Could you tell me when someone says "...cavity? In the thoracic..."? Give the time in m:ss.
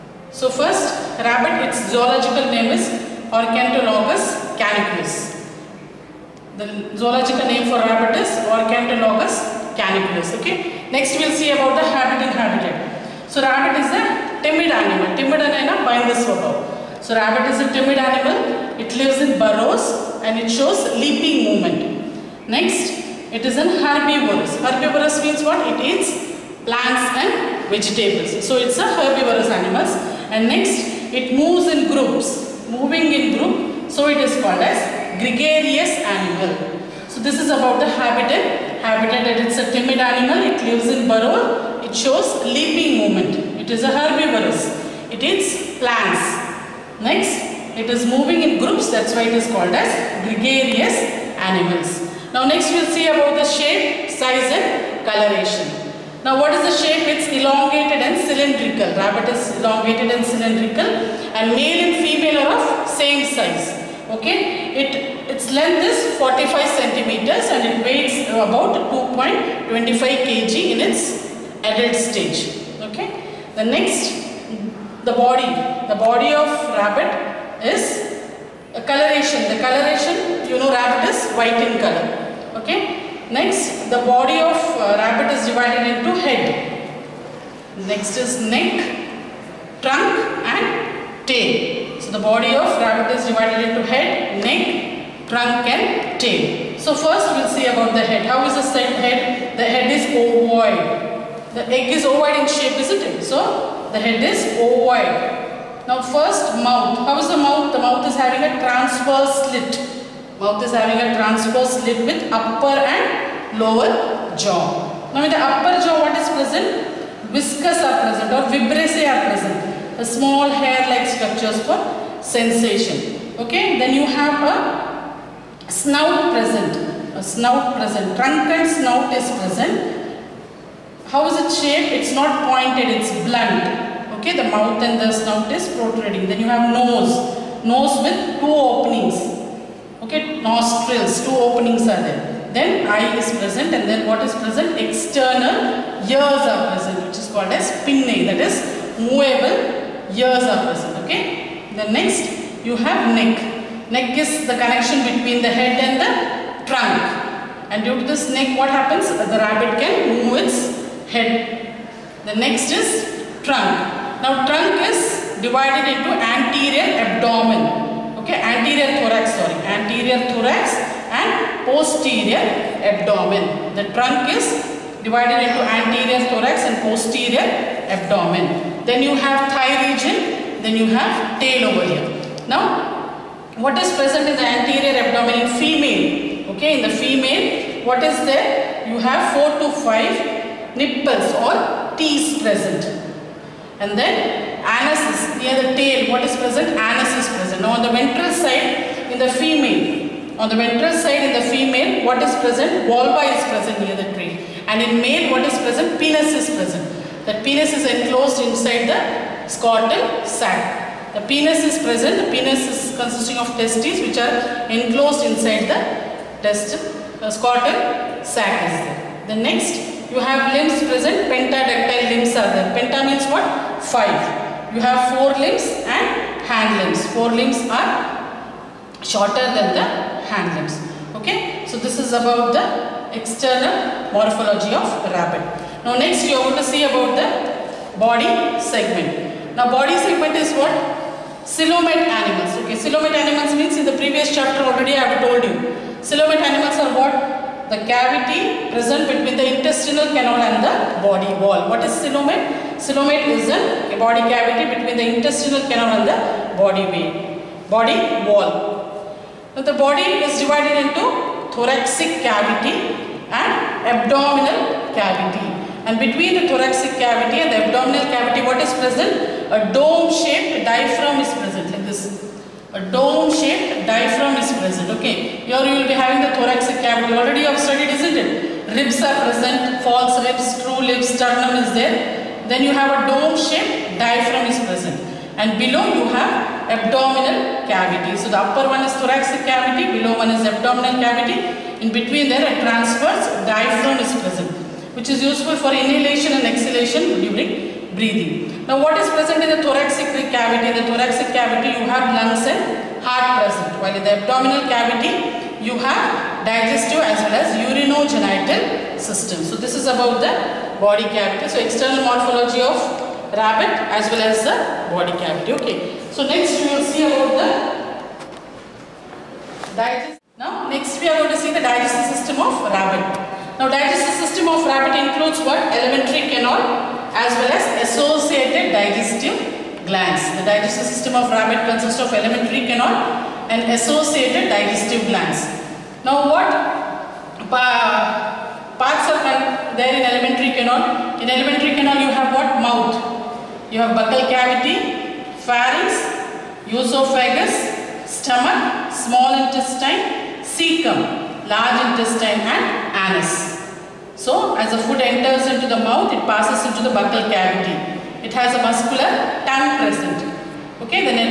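5:00.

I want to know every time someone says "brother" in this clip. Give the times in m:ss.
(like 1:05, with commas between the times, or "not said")
not said.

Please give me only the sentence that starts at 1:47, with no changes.
The mouth is having a transverse slit.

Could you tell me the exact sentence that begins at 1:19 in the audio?
The coloration, you know, rabbit is white in color.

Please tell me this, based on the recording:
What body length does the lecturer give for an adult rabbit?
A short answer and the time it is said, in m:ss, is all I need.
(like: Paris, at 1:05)
45 centimeters, at 1:06.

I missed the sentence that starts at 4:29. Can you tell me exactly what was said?
A dome-shaped diaphragm is present a dome shaped diaphragm is present.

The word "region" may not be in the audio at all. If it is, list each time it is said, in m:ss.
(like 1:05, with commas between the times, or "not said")
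2:59.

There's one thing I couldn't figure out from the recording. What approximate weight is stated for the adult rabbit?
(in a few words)
2.25 kg.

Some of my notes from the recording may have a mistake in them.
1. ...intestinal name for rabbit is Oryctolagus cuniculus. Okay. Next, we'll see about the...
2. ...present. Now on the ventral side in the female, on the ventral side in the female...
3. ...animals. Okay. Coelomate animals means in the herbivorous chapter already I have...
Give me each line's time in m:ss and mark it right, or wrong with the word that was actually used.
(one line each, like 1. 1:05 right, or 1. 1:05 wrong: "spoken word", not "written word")
1. 0:06 wrong: "zoological", not "intestinal"
2. 3:17 right
3. 4:02 wrong: "previous", not "herbivorous".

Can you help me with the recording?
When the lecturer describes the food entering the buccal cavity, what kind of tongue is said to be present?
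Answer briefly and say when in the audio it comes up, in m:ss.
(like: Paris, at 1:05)
muscular tongue, at 5:58.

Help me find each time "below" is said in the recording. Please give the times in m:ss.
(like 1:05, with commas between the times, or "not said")
4:45, 4:49.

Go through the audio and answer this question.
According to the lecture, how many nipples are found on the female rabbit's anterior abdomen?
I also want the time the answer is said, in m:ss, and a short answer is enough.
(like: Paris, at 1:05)
4 to 5, at 3:09.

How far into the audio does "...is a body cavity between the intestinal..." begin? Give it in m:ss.
4:13.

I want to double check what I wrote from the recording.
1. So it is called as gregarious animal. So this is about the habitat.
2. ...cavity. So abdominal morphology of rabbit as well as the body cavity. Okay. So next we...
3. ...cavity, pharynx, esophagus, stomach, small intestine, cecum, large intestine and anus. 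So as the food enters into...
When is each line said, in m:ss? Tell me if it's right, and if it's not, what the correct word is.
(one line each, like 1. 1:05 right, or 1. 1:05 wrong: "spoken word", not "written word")
1. 0:33 right
2. 5:11 wrong: "external", not "abdominal"
3. 5:44 right.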